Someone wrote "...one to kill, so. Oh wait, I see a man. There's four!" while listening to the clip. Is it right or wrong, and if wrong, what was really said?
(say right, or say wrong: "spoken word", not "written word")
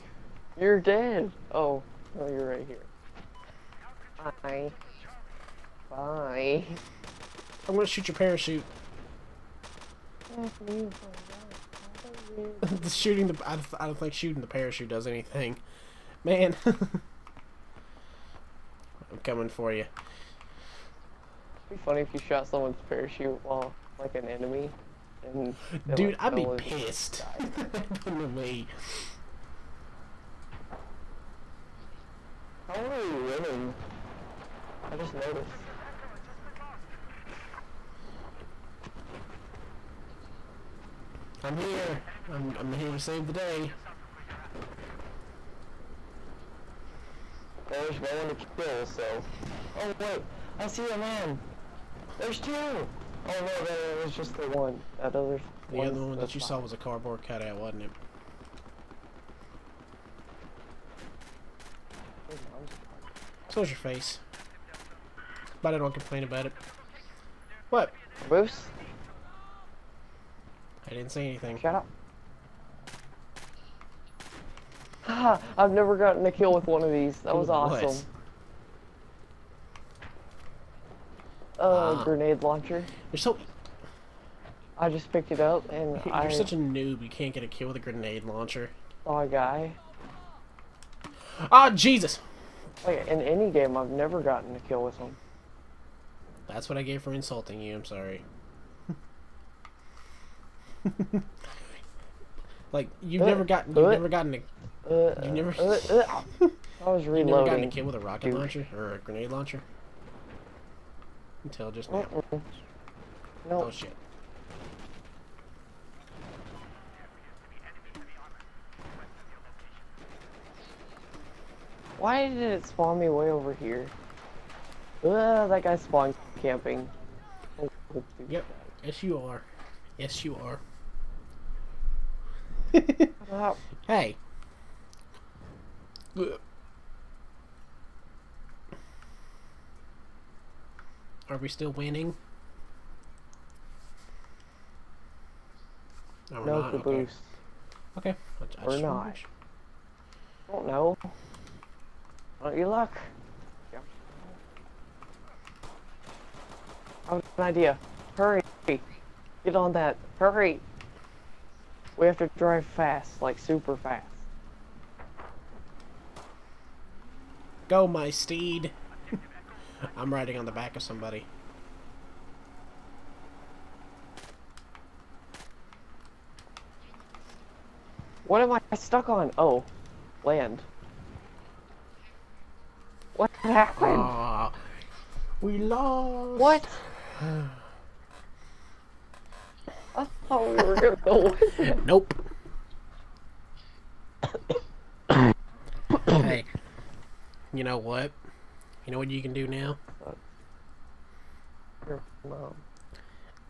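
wrong: "two", not "four".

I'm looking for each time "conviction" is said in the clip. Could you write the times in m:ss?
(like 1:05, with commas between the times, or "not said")
not said.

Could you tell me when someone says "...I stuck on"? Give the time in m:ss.
2:58.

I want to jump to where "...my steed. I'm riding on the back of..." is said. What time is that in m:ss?
2:47.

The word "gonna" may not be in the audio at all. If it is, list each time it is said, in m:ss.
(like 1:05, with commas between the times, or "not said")
0:07, 3:10.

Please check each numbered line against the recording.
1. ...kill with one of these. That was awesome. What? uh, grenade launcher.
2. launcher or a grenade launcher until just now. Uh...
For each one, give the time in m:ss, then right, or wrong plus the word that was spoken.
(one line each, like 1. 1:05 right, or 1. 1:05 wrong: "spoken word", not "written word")
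1. 1:16 right
2. 1:48 right.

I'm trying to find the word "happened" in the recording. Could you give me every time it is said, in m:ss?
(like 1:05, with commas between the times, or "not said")
0:27, 3:03.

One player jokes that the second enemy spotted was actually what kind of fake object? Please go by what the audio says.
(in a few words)
Cardboard cutout.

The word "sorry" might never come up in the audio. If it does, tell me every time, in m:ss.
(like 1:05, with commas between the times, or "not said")
1:37.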